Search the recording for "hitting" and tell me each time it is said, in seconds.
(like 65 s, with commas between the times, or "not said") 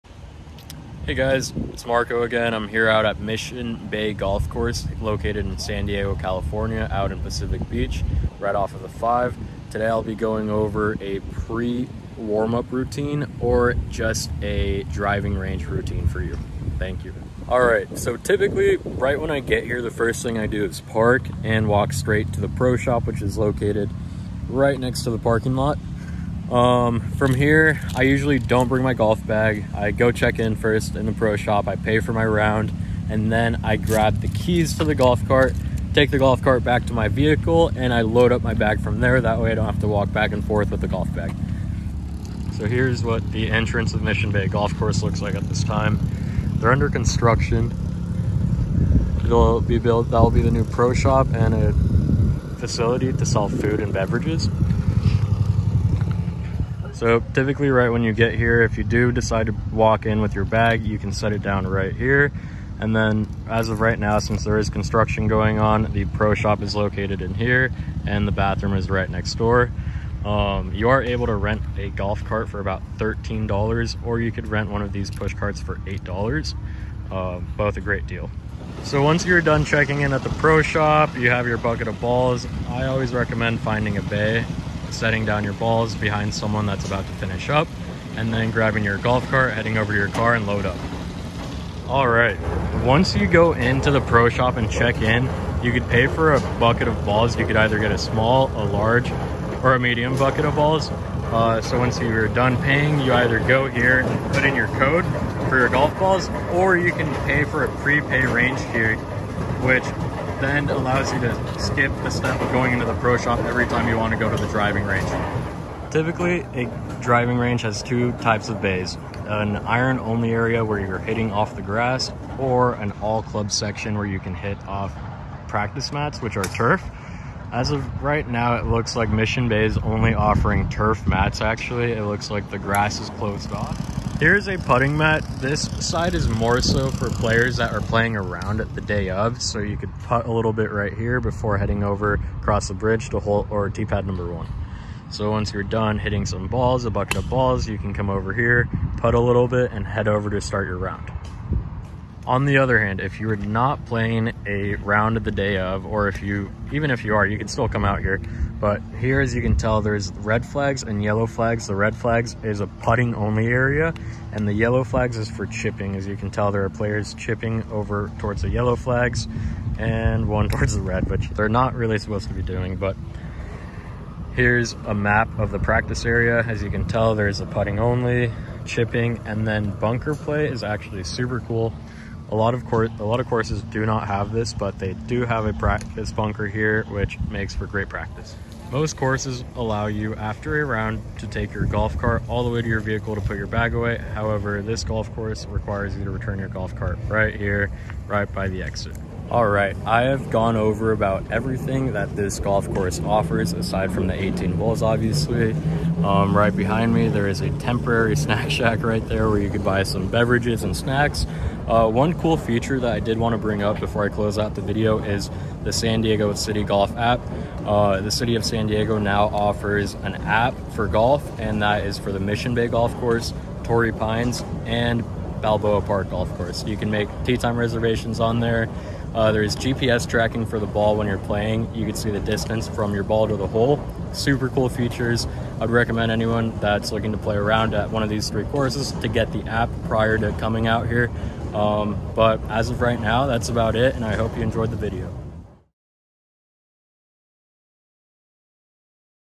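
120 s, 145 s.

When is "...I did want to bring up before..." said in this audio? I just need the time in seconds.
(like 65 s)
212 s.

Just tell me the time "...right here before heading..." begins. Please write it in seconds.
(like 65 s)
140 s.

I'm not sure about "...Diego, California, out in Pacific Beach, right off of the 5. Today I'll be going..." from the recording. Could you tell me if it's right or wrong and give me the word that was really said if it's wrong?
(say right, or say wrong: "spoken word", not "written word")
right.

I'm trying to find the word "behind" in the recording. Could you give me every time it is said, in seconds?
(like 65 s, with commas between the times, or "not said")
85 s, 206 s.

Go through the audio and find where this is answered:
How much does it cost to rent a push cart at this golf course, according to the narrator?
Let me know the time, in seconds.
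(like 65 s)
75 s.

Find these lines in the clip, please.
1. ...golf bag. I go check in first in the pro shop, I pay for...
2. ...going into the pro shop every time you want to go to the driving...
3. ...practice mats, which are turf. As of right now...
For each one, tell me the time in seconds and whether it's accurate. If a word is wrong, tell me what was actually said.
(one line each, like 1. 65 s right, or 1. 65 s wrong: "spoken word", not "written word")
1. 28 s right
2. 112 s right
3. 125 s right.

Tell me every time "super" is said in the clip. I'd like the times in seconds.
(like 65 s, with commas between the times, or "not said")
181 s, 234 s.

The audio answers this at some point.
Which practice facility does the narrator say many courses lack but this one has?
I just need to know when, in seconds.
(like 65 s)
185 s.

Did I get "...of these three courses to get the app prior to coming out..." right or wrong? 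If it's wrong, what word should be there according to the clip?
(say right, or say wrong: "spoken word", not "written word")
right.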